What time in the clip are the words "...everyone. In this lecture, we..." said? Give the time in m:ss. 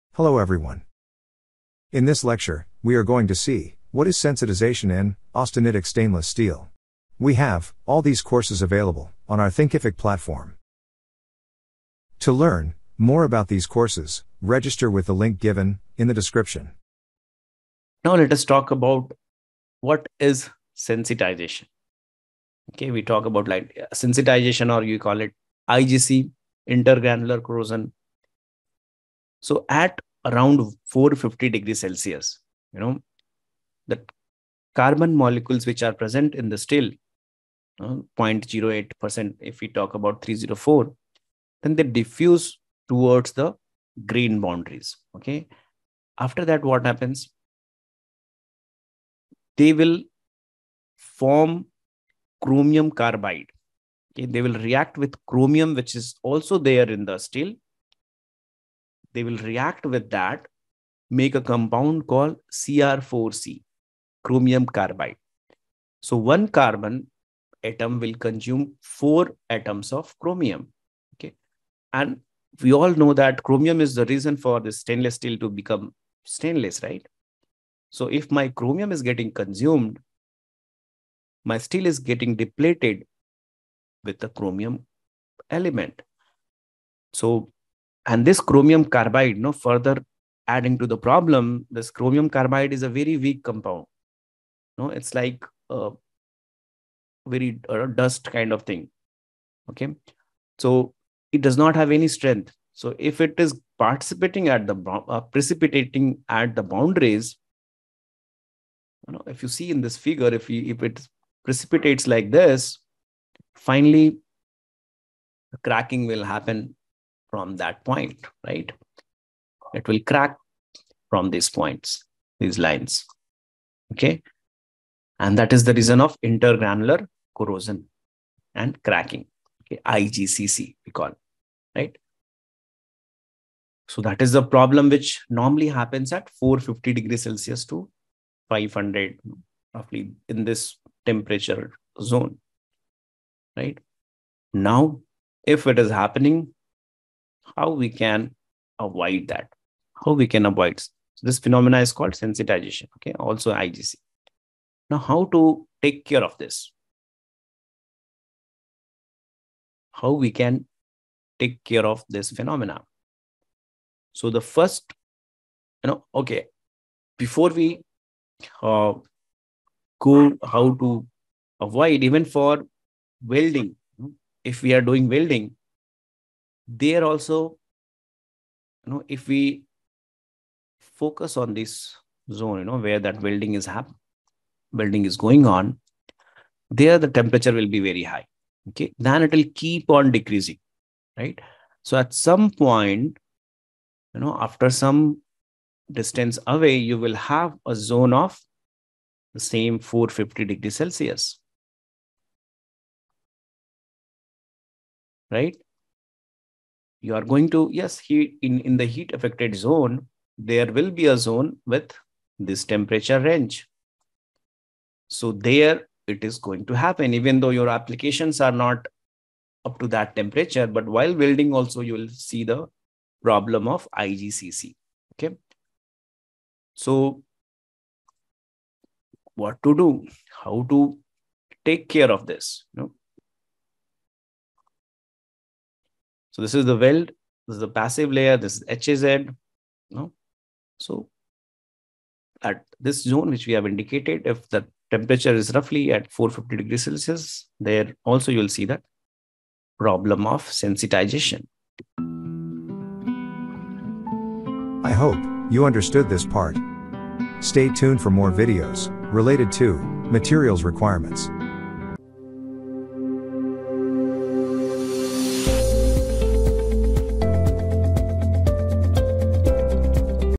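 0:00.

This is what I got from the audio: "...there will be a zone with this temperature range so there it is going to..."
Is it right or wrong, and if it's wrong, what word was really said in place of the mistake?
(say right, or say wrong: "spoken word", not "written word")
right.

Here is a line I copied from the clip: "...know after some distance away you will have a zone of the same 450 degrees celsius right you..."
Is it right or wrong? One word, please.
right.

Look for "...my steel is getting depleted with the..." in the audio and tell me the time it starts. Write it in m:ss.
1:21.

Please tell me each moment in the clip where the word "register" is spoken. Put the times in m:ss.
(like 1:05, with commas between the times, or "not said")
0:14.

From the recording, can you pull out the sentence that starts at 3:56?
So this is the weld, this is the passive layer, this is HZ.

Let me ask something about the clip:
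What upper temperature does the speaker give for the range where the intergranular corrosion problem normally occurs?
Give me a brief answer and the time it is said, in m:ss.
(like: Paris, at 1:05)
500 degrees Celsius, at 2:18.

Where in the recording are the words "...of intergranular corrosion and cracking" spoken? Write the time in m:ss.
2:06.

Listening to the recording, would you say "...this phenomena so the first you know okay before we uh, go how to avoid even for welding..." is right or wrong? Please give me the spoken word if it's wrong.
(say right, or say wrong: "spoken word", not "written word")
right.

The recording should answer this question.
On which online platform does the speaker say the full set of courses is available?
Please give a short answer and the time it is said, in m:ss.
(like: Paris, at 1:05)
Thinkific, at 0:09.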